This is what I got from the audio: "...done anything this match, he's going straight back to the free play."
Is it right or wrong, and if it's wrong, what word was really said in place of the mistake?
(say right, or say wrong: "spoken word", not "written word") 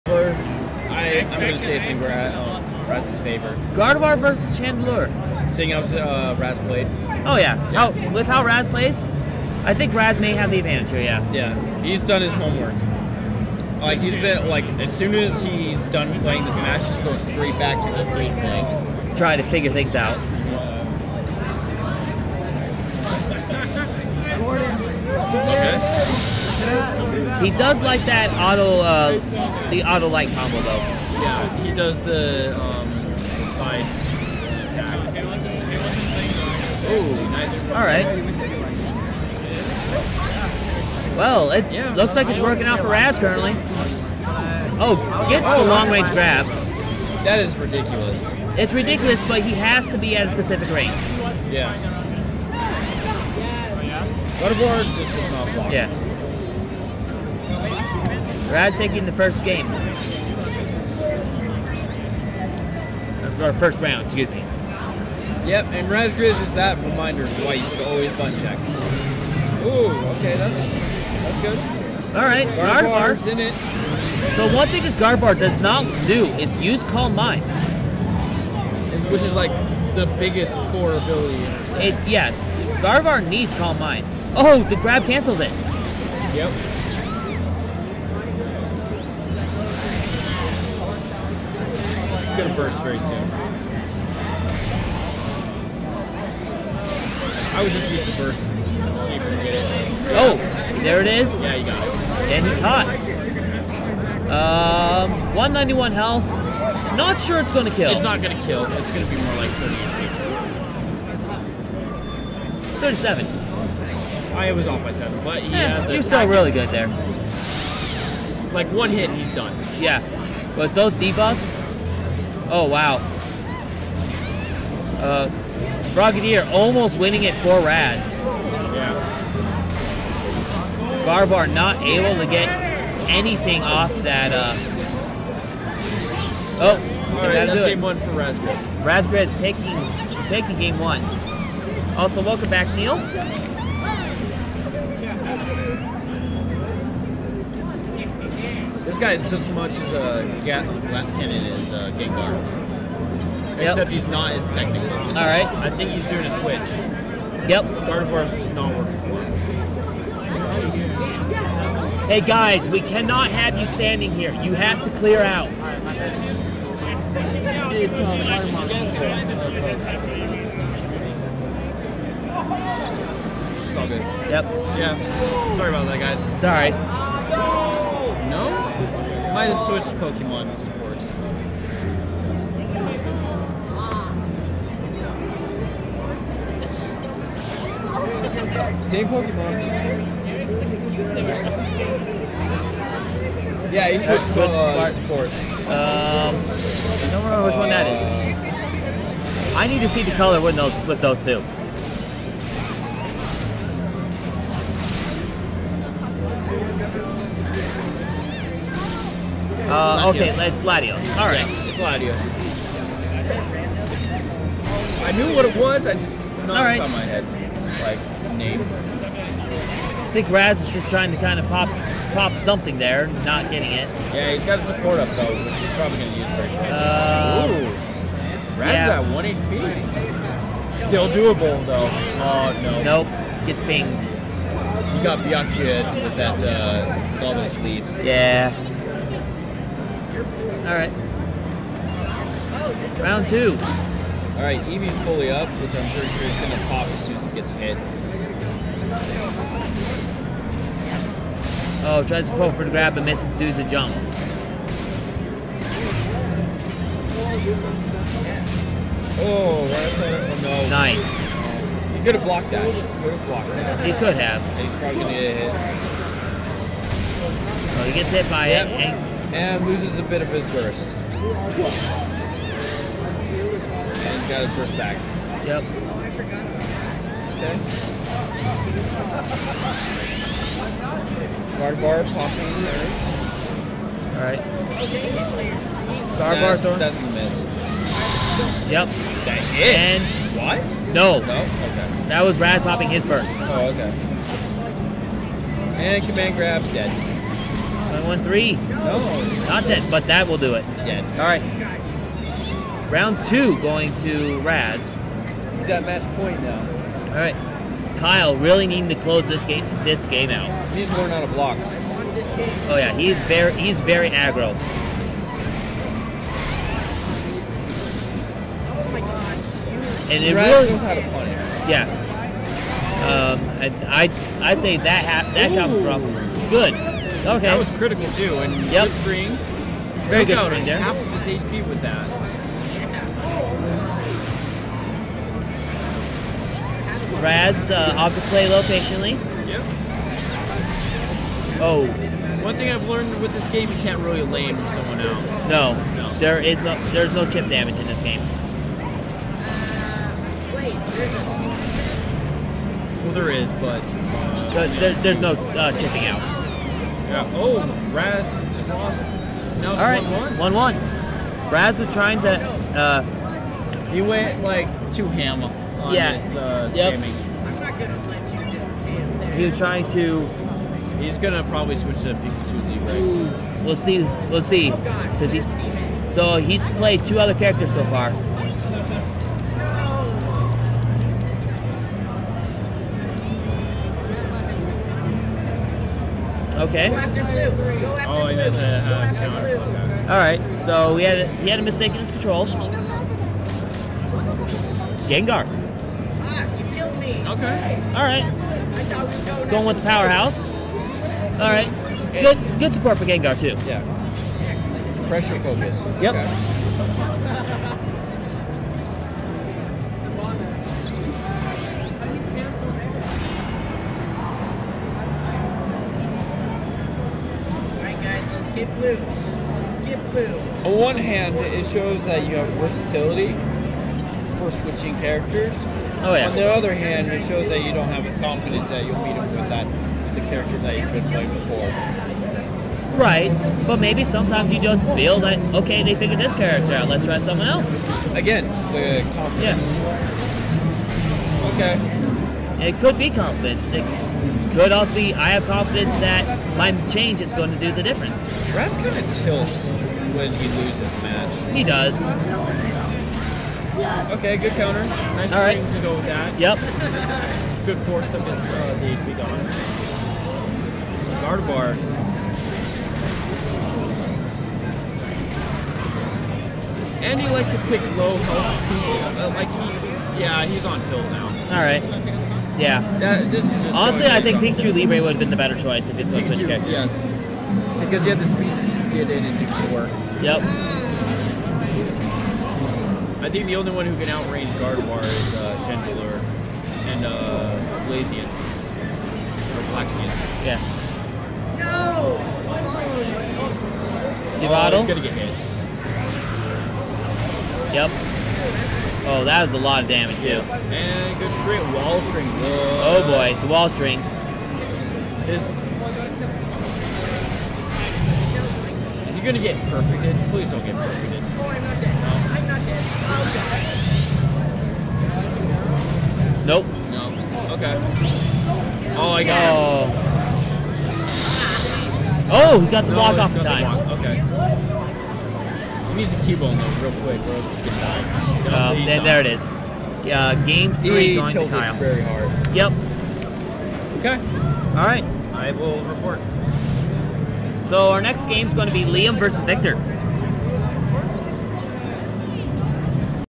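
wrong: "playing", not "anything".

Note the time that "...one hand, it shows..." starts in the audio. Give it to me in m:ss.
7:00.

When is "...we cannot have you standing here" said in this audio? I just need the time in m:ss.
2:42.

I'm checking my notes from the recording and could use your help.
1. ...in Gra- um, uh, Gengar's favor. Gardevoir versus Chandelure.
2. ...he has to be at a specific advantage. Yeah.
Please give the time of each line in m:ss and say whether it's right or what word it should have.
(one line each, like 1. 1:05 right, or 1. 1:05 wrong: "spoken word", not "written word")
1. 0:01 wrong: "Raz", not "Gengar"
2. 0:49 wrong: "range", not "advantage".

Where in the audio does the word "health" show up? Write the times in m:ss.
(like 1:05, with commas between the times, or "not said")
1:45, 7:48.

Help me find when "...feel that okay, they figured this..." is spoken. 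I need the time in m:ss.
7:14.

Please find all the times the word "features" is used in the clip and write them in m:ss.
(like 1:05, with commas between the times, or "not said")
not said.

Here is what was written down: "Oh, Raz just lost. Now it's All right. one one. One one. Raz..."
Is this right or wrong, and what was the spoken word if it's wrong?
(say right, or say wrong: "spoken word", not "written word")
right.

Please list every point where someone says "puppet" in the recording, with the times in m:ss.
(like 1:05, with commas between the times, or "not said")
not said.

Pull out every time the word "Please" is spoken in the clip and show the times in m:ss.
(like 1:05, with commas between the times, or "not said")
8:30.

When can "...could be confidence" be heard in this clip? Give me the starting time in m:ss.
7:22.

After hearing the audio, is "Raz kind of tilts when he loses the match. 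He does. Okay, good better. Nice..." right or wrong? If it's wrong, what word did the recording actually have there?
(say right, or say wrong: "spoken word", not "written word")
wrong: "counter", not "better".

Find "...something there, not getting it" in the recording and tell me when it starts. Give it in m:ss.
3:42.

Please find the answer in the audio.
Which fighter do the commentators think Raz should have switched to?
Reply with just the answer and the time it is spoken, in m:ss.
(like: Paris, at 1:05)
Pikachu Libre, at 7:54.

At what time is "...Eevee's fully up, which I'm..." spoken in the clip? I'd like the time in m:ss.
4:04.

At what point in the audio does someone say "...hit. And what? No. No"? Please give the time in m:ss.
4:49.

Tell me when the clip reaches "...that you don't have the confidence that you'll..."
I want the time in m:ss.
7:07.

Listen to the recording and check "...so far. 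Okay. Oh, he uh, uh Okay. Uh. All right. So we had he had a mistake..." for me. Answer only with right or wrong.
right.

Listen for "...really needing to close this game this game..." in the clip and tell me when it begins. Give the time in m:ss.
5:08.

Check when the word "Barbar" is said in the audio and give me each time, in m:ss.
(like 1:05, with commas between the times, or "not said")
4:41, 4:46.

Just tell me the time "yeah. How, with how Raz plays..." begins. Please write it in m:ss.
0:07.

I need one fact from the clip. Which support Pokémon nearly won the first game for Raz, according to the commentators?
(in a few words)
Frogadier.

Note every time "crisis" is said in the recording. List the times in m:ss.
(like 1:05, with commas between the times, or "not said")
not said.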